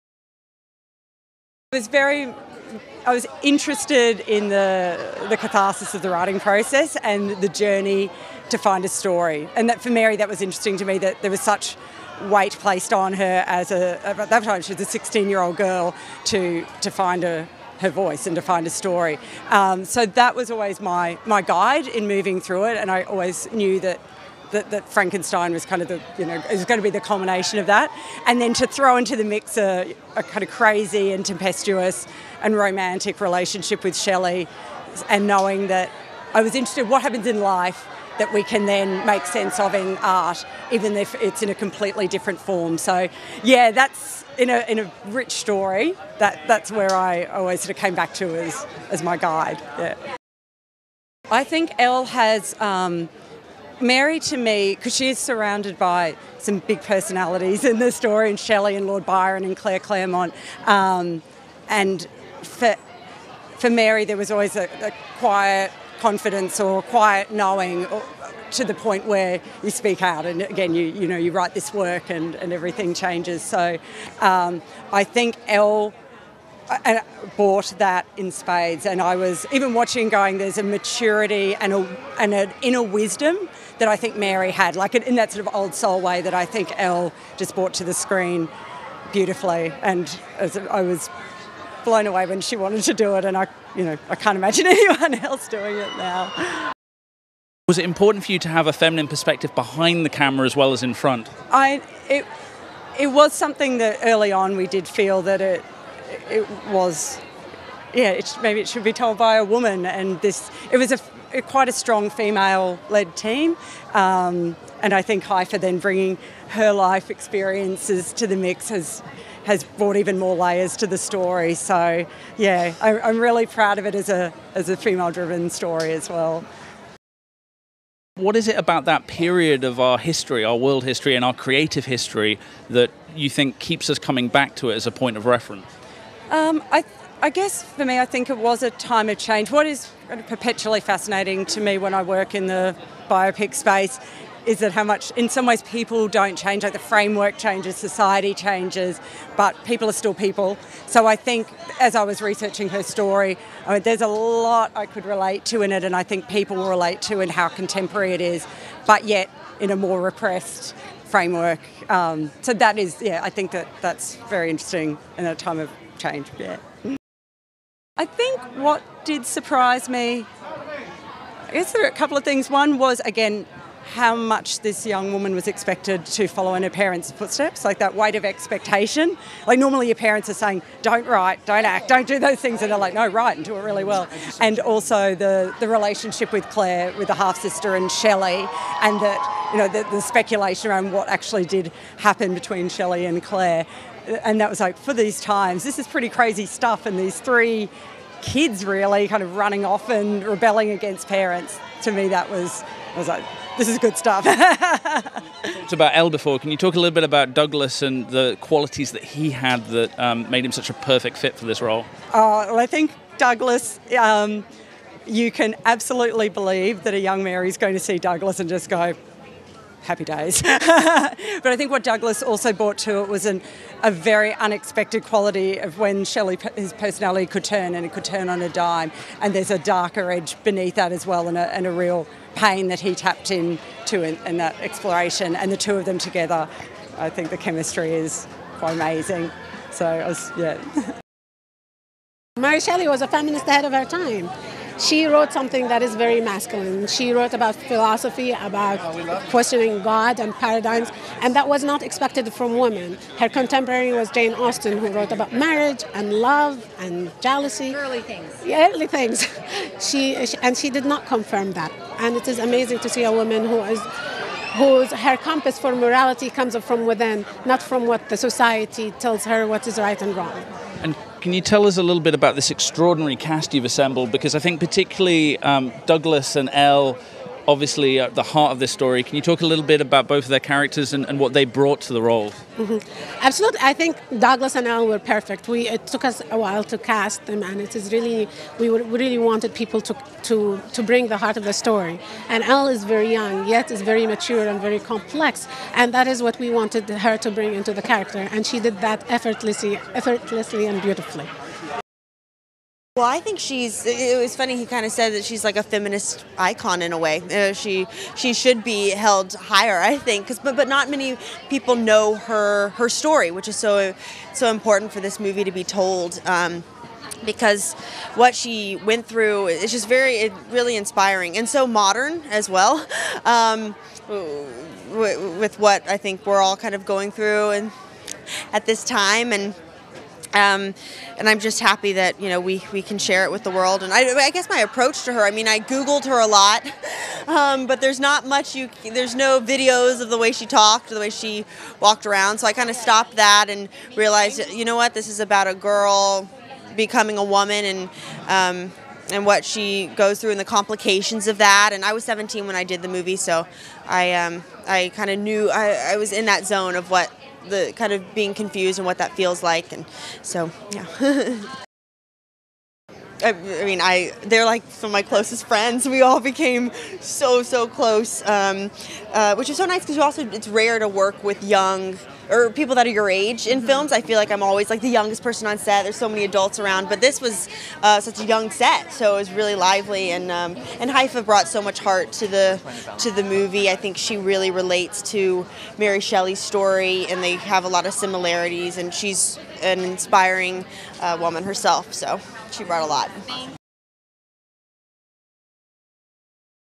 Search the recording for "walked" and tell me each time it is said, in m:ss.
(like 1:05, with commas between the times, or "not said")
5:41.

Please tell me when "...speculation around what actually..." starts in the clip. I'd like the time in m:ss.
3:10.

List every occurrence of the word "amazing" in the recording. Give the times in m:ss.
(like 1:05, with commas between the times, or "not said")
3:58, 4:22.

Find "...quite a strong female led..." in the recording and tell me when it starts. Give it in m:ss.
1:51.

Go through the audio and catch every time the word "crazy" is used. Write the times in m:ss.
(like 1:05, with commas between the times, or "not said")
0:30, 3:16.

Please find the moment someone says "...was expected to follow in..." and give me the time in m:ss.
2:55.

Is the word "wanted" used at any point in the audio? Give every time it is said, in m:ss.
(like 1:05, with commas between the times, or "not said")
1:32, 4:49, 4:56.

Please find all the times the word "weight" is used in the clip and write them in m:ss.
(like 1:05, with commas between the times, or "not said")
0:12, 2:57.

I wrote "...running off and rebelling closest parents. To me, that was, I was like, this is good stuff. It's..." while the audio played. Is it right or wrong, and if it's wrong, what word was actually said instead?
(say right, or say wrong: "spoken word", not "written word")
wrong: "against", not "closest".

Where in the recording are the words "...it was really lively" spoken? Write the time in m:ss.
6:19.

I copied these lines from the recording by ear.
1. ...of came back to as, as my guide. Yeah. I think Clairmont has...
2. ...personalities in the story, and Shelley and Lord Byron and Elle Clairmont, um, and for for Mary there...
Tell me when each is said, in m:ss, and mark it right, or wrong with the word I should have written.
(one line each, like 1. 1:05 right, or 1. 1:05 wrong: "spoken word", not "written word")
1. 0:47 wrong: "Elle", not "Clairmont"
2. 0:56 wrong: "Claire", not "Elle".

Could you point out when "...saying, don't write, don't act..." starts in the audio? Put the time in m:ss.
3:00.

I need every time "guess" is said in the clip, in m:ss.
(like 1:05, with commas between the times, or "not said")
2:17, 2:51, 5:34.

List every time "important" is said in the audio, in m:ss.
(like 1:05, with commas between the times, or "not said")
1:37, 5:14.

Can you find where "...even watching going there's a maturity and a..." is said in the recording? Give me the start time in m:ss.
1:19.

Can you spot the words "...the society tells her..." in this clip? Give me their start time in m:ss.
4:28.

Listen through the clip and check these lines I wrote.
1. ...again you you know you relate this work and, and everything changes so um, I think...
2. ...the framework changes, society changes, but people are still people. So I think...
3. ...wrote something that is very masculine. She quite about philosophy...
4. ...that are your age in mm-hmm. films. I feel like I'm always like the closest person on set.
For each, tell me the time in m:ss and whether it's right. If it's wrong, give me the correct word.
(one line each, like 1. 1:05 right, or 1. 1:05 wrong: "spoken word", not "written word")
1. 1:10 wrong: "write", not "relate"
2. 2:26 right
3. 4:05 wrong: "wrote", not "quite"
4. 6:12 wrong: "youngest", not "closest".